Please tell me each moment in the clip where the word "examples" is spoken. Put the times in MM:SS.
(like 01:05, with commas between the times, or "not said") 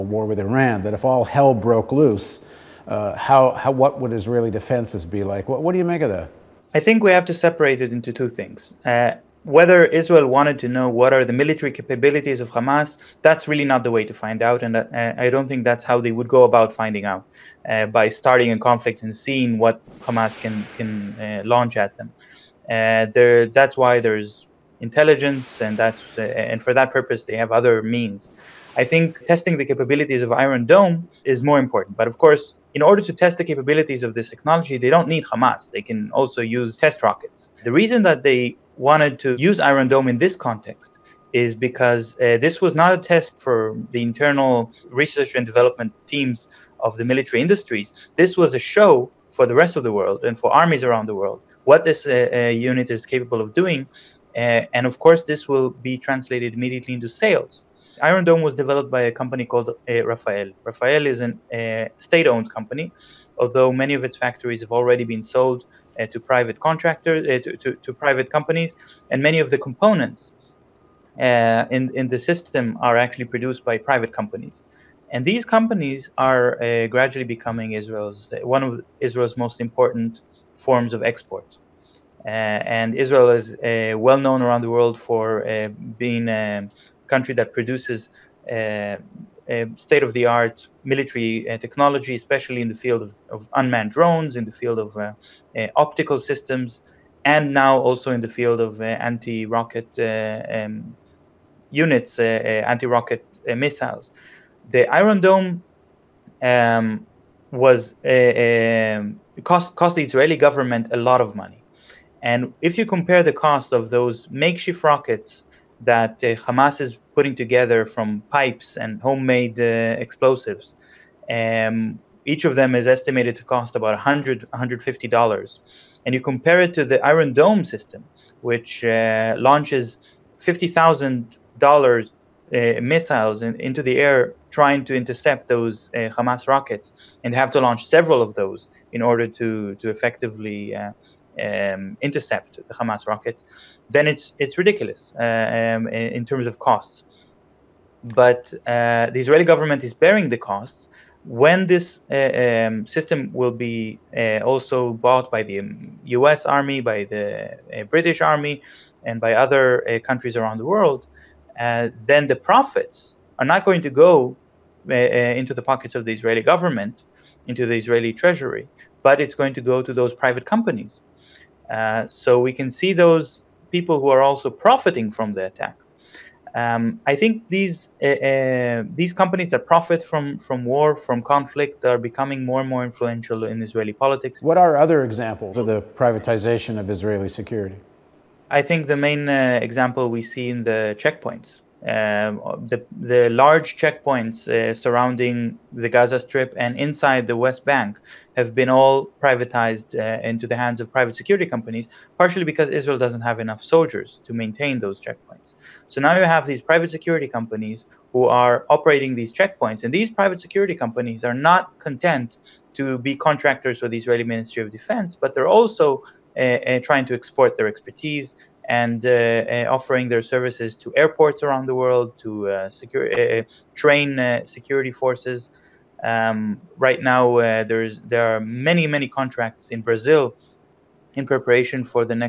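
03:05, 03:09.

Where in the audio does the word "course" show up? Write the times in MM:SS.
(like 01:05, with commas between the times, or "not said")
00:32, 00:54.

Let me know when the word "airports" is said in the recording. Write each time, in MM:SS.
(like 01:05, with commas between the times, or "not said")
03:40.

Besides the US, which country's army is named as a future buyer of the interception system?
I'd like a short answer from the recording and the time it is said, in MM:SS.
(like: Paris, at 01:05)
British, at 02:37.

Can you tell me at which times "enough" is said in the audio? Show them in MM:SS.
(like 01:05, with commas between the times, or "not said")
03:23.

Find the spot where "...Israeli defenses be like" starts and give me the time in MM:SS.
00:04.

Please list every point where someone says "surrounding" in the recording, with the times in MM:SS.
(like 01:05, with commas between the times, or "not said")
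03:14.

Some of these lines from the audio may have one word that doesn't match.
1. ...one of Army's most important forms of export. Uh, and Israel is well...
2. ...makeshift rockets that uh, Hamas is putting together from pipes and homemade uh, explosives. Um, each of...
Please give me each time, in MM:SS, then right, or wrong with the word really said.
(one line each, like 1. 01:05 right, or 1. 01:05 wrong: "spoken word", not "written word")
1. 01:18 wrong: "Israel", not "Army"
2. 01:54 right.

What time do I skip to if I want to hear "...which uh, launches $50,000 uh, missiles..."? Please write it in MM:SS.
02:08.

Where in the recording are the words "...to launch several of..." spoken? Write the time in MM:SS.
02:17.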